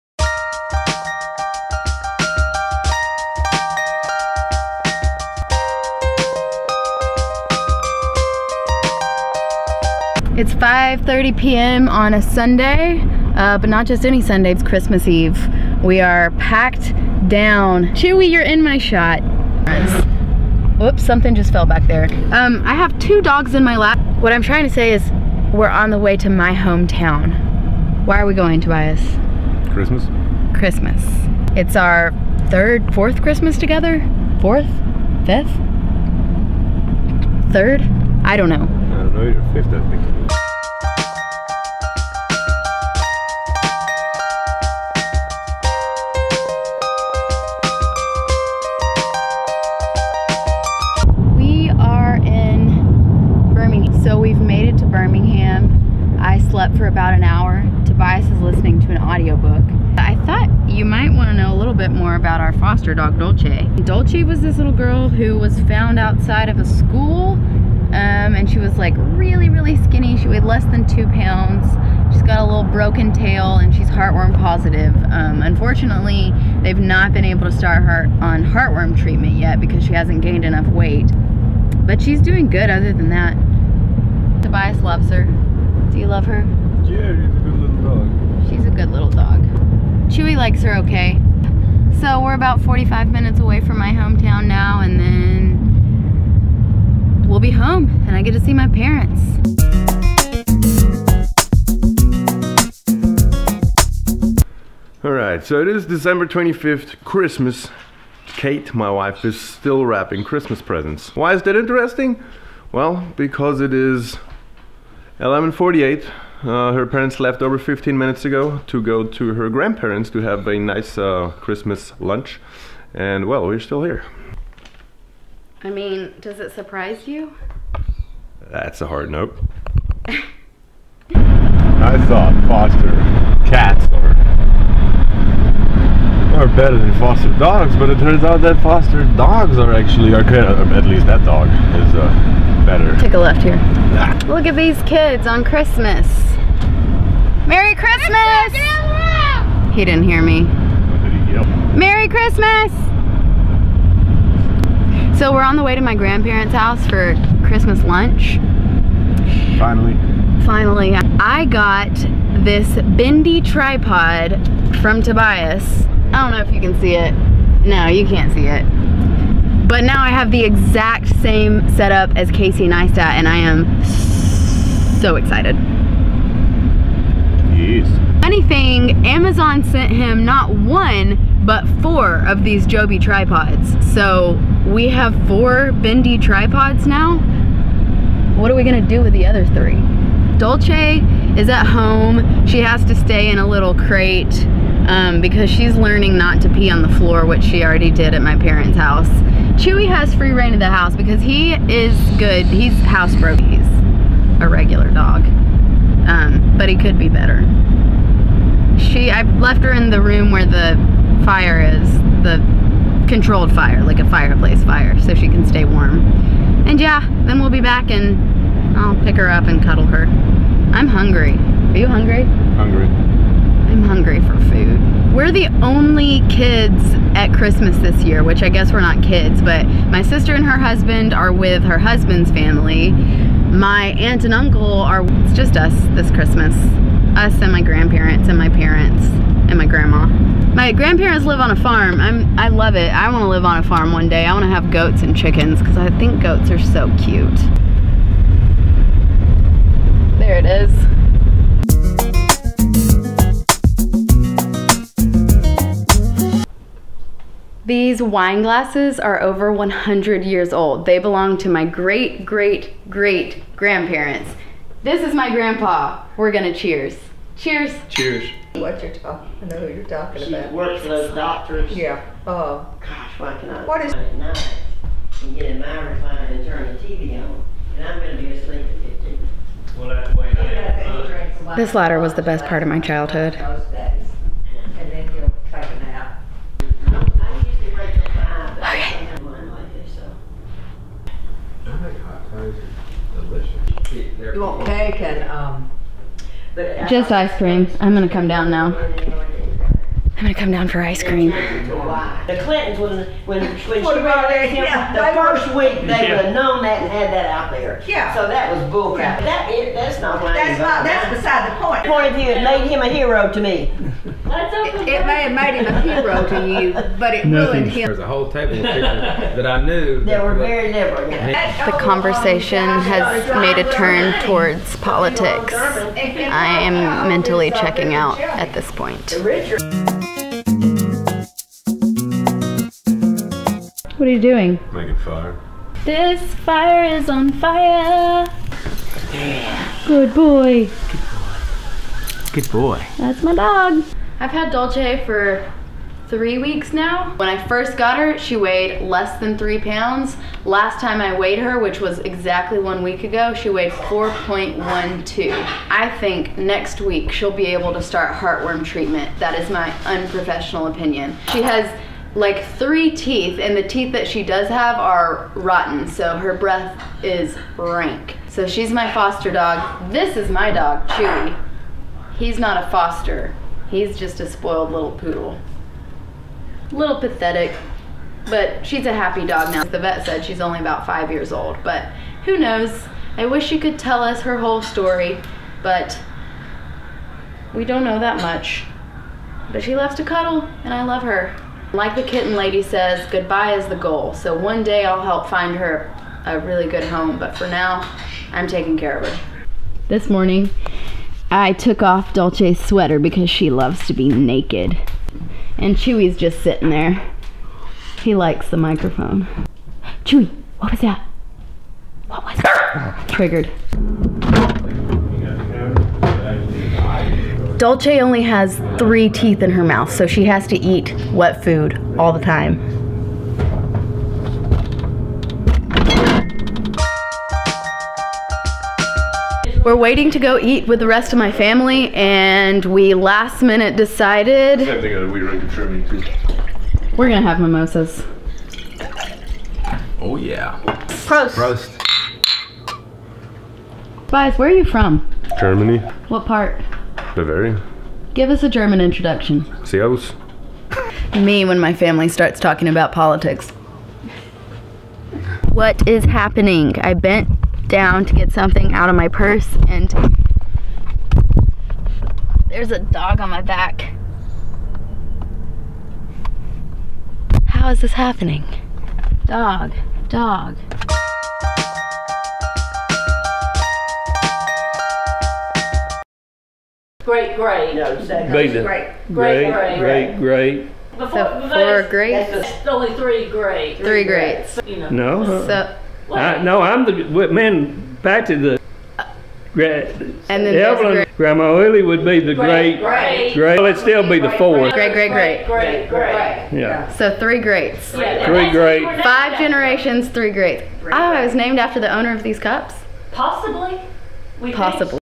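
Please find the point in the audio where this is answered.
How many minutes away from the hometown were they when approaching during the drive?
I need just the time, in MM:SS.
01:32.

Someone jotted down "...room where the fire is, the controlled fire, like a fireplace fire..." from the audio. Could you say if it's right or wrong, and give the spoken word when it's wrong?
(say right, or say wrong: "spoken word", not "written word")
right.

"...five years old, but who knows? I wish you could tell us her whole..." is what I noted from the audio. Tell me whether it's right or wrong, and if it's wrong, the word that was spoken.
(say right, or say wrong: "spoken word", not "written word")
right.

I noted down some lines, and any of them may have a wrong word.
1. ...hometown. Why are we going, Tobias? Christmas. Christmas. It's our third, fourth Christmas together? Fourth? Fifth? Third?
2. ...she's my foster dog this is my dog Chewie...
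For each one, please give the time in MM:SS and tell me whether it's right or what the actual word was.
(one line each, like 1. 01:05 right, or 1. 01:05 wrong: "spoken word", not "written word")
1. 00:26 right
2. 06:08 right.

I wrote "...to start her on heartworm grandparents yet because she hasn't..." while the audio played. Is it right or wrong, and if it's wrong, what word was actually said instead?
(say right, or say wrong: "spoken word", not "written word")
wrong: "treatment", not "grandparents".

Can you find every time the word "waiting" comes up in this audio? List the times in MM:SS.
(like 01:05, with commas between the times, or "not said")
07:09.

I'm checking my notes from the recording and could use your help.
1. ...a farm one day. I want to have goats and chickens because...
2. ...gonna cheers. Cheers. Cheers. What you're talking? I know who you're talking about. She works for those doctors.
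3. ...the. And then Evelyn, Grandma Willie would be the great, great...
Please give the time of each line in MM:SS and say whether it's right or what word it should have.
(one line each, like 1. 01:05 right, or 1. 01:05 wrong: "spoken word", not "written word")
1. 04:03 right
2. 04:26 right
3. 08:08 right.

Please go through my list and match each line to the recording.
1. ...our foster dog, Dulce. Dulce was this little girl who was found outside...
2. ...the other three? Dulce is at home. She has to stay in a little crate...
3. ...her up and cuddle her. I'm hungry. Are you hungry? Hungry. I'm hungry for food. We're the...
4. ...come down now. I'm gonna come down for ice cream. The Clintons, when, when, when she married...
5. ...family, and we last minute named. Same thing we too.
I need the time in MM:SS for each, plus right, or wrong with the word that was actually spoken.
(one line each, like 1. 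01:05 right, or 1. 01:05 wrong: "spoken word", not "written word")
1. 01:02 right
2. 03:09 right
3. 03:39 right
4. 04:58 right
5. 07:11 wrong: "decided", not "named".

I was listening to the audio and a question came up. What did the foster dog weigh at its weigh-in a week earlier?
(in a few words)
4.12.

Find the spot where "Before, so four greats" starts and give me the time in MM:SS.
08:00.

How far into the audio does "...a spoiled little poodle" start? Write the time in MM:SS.
06:14.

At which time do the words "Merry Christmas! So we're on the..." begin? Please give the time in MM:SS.
02:31.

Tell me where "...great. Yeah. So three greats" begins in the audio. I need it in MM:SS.
08:15.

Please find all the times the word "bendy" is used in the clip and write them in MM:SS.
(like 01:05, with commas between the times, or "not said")
02:42, 03:05.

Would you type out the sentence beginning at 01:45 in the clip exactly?
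All right, so it is December 25th, Christmas.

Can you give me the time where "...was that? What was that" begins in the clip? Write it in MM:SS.
06:50.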